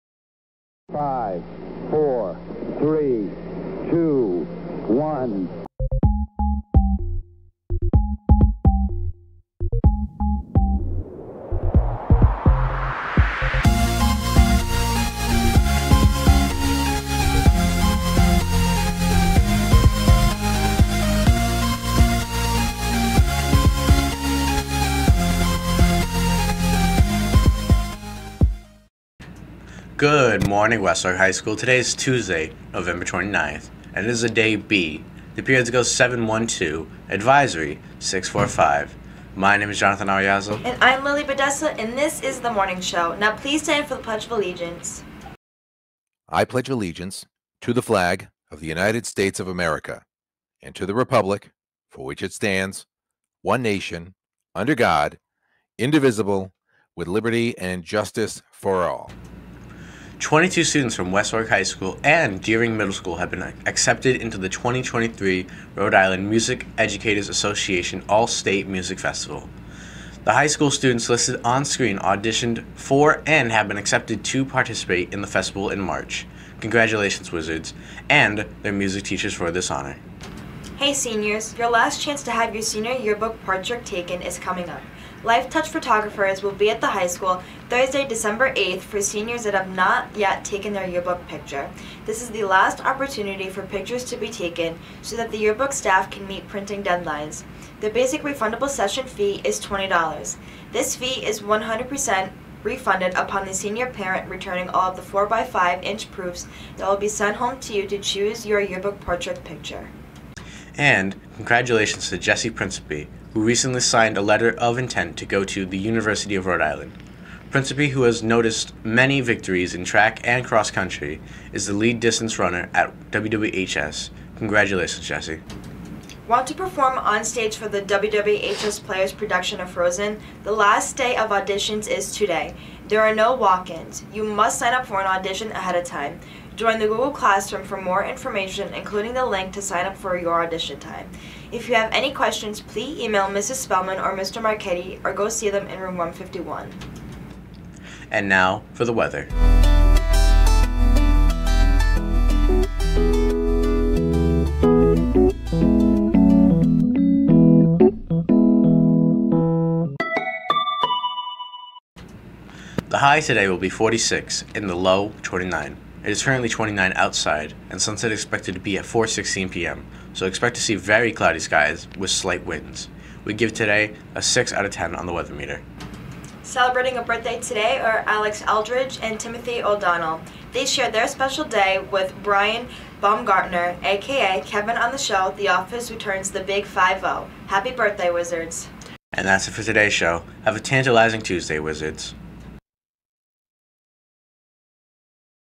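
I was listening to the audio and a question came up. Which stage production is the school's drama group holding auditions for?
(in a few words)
Frozen.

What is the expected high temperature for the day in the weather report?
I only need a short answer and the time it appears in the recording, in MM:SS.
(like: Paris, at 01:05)
46, at 02:43.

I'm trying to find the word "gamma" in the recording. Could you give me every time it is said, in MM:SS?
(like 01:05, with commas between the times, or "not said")
not said.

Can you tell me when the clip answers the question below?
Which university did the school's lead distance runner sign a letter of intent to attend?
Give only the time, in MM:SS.
01:55.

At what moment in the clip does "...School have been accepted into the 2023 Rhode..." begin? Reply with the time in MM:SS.
01:02.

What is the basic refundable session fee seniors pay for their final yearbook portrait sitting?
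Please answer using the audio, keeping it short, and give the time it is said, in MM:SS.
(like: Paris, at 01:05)
$20, at 01:39.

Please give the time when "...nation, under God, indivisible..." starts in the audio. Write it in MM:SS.
00:53.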